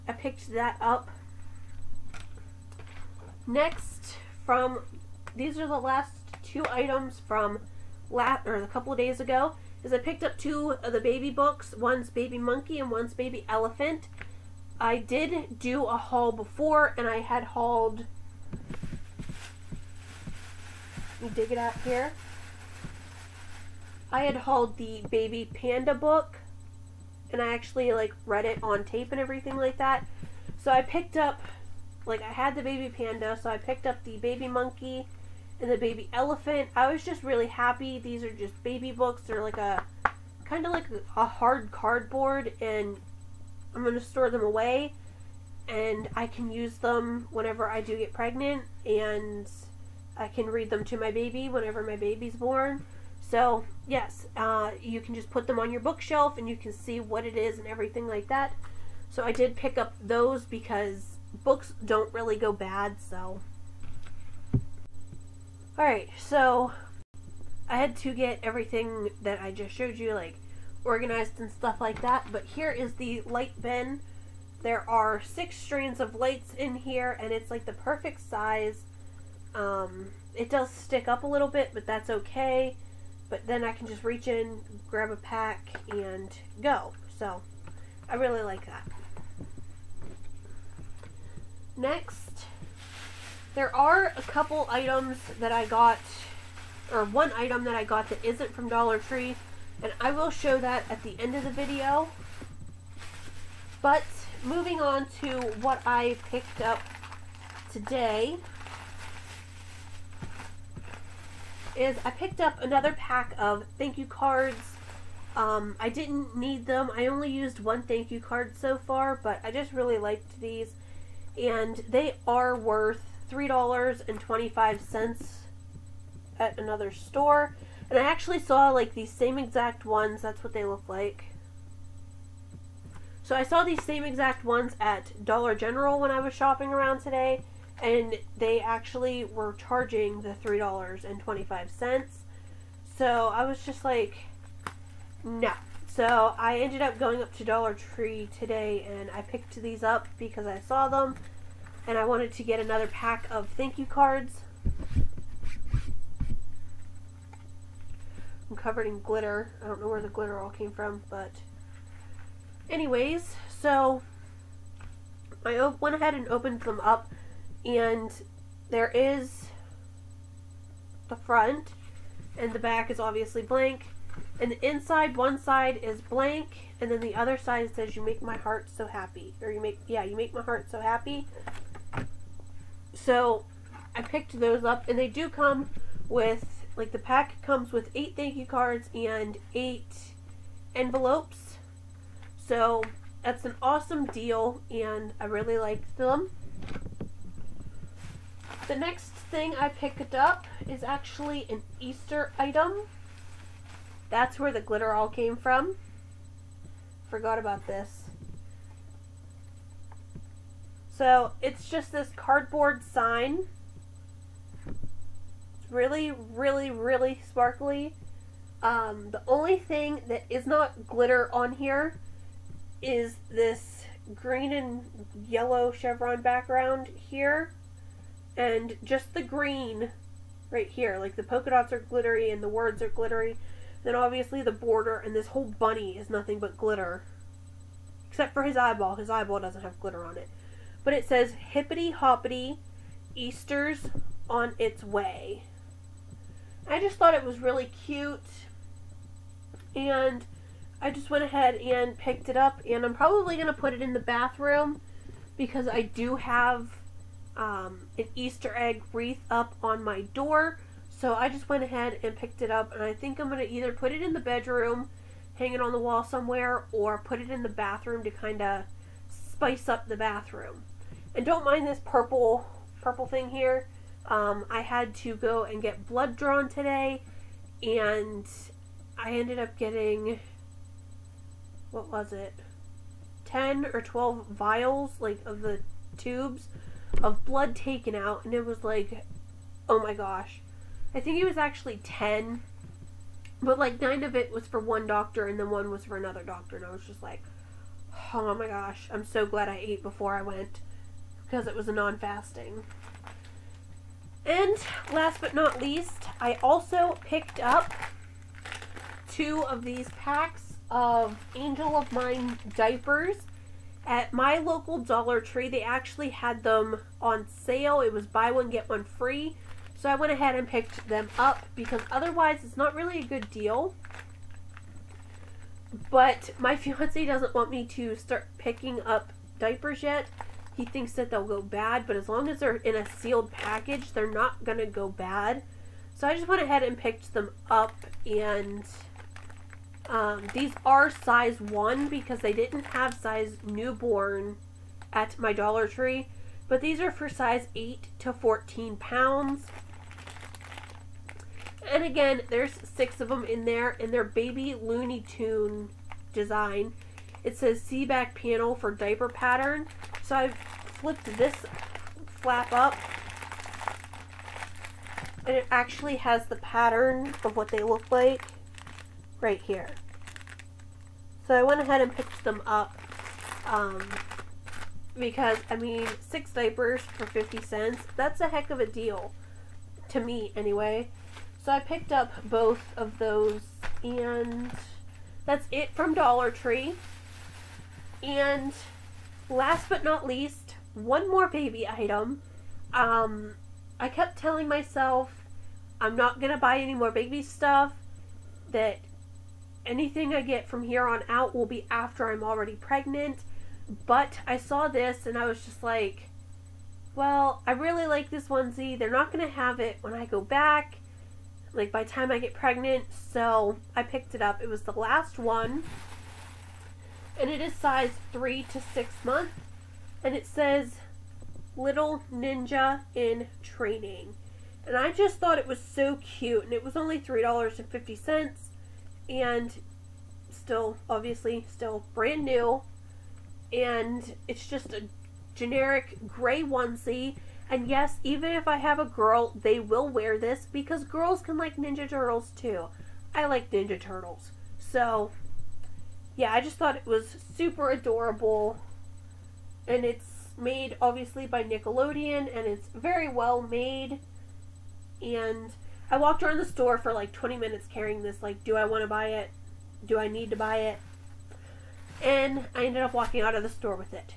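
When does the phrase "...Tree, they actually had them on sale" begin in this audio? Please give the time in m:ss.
5:15.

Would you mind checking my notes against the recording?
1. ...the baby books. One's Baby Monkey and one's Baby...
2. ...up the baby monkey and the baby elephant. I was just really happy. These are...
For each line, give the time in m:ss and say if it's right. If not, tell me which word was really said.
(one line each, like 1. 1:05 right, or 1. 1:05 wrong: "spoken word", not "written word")
1. 0:10 right
2. 0:33 right.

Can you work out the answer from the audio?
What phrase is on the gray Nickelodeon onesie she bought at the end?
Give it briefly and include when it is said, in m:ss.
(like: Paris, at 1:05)
Little Ninja in Training, at 7:01.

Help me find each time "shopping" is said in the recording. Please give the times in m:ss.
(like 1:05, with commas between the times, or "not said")
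2:16.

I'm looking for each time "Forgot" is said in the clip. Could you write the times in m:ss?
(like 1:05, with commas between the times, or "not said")
3:27.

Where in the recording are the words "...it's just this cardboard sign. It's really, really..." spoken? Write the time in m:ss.
3:31.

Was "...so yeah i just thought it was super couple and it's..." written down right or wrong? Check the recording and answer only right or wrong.
wrong.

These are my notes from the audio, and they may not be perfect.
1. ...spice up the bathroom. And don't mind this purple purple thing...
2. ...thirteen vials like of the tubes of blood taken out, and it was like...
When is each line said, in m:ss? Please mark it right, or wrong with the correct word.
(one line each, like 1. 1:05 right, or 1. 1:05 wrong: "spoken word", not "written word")
1. 4:29 right
2. 4:43 wrong: "twelve", not "thirteen".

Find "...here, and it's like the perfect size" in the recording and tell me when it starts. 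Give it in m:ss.
1:16.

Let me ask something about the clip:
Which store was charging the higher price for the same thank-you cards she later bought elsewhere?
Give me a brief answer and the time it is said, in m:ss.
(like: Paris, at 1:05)
Dollar General, at 2:15.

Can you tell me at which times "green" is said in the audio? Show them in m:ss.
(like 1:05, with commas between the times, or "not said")
3:44, 3:49.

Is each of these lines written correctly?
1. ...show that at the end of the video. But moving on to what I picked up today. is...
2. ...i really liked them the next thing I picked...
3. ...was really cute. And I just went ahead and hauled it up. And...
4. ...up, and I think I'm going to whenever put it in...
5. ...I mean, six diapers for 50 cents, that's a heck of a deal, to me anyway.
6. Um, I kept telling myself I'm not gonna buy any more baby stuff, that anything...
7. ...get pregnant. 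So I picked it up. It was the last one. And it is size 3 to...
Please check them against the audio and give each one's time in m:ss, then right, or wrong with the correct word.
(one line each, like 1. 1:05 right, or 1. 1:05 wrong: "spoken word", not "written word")
1. 1:40 right
2. 3:15 right
3. 4:07 wrong: "picked", not "hauled"
4. 4:22 wrong: "either", not "whenever"
5. 6:15 right
6. 6:32 right
7. 6:52 right.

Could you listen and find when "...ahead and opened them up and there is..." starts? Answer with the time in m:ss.
2:45.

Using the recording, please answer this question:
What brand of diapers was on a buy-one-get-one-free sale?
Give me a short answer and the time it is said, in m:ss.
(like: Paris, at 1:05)
Angel of Mine, at 5:11.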